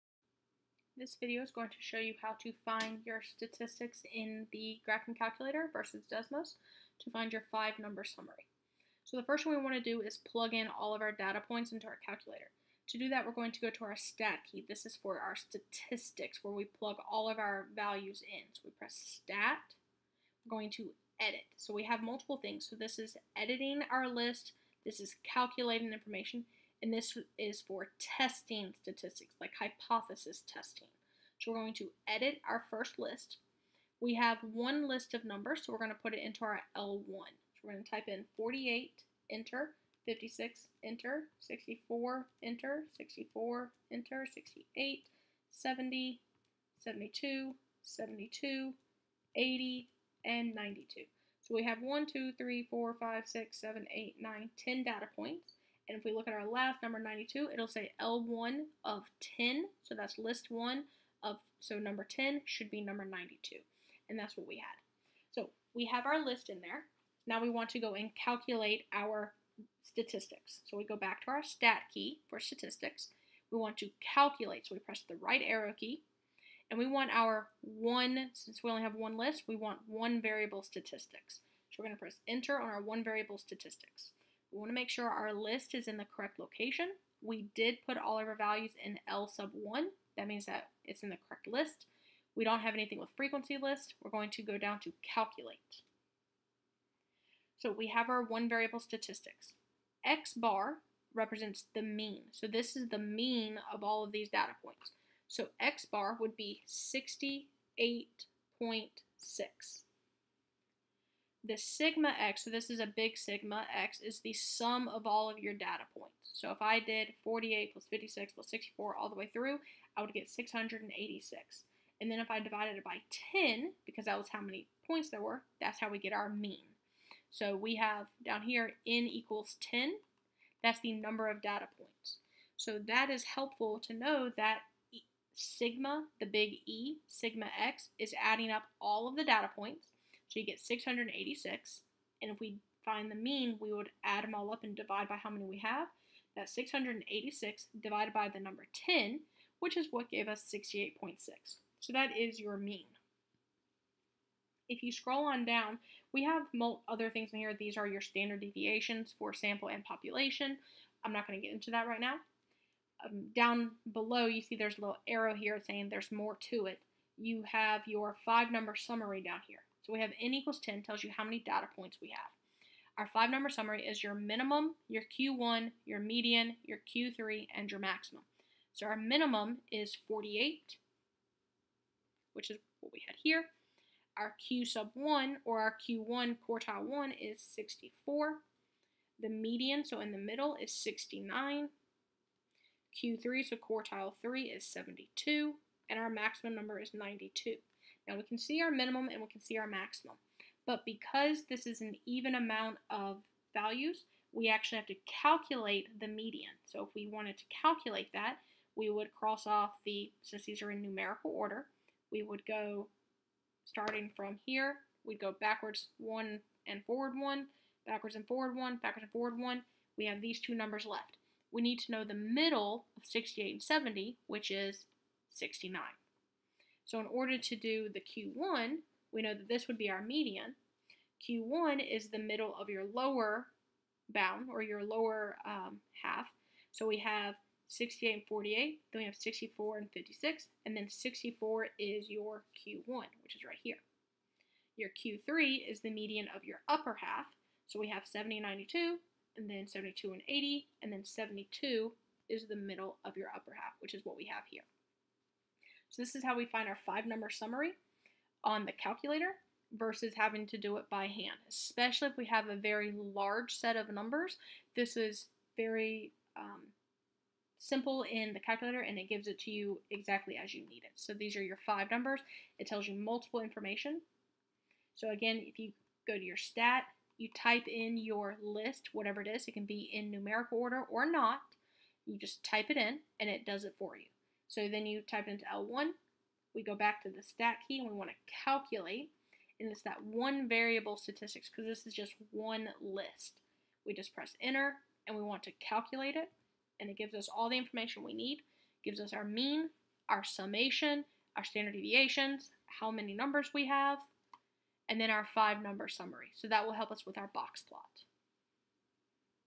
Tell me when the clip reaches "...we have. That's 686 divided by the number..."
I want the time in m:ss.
2:25.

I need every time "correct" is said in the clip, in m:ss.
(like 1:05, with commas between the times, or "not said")
1:26, 1:31.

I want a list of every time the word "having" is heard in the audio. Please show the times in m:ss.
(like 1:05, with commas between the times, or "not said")
4:20.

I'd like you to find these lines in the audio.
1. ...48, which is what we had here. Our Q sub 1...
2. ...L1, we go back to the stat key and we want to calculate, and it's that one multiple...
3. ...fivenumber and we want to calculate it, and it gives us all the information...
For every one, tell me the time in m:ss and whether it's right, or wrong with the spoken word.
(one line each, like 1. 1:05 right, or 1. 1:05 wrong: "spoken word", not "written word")
1. 3:00 right
2. 4:45 wrong: "variable", not "multiple"
3. 4:54 wrong: "enter", not "fivenumber".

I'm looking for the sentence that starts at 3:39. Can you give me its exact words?
We have these two numbers left.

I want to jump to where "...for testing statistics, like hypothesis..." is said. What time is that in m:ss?
0:27.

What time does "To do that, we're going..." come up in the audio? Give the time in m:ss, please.
0:12.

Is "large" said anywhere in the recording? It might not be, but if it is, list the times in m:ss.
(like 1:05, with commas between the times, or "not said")
4:22.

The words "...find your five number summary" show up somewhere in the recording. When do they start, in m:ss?
0:07.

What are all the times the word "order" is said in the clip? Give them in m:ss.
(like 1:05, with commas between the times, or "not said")
3:31, 3:47, 4:40.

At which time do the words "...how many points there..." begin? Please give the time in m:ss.
2:04.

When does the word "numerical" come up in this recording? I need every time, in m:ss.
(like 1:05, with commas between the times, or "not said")
3:30, 4:40.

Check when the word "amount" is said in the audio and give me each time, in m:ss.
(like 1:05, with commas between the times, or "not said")
3:22.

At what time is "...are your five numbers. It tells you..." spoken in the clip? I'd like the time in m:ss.
4:31.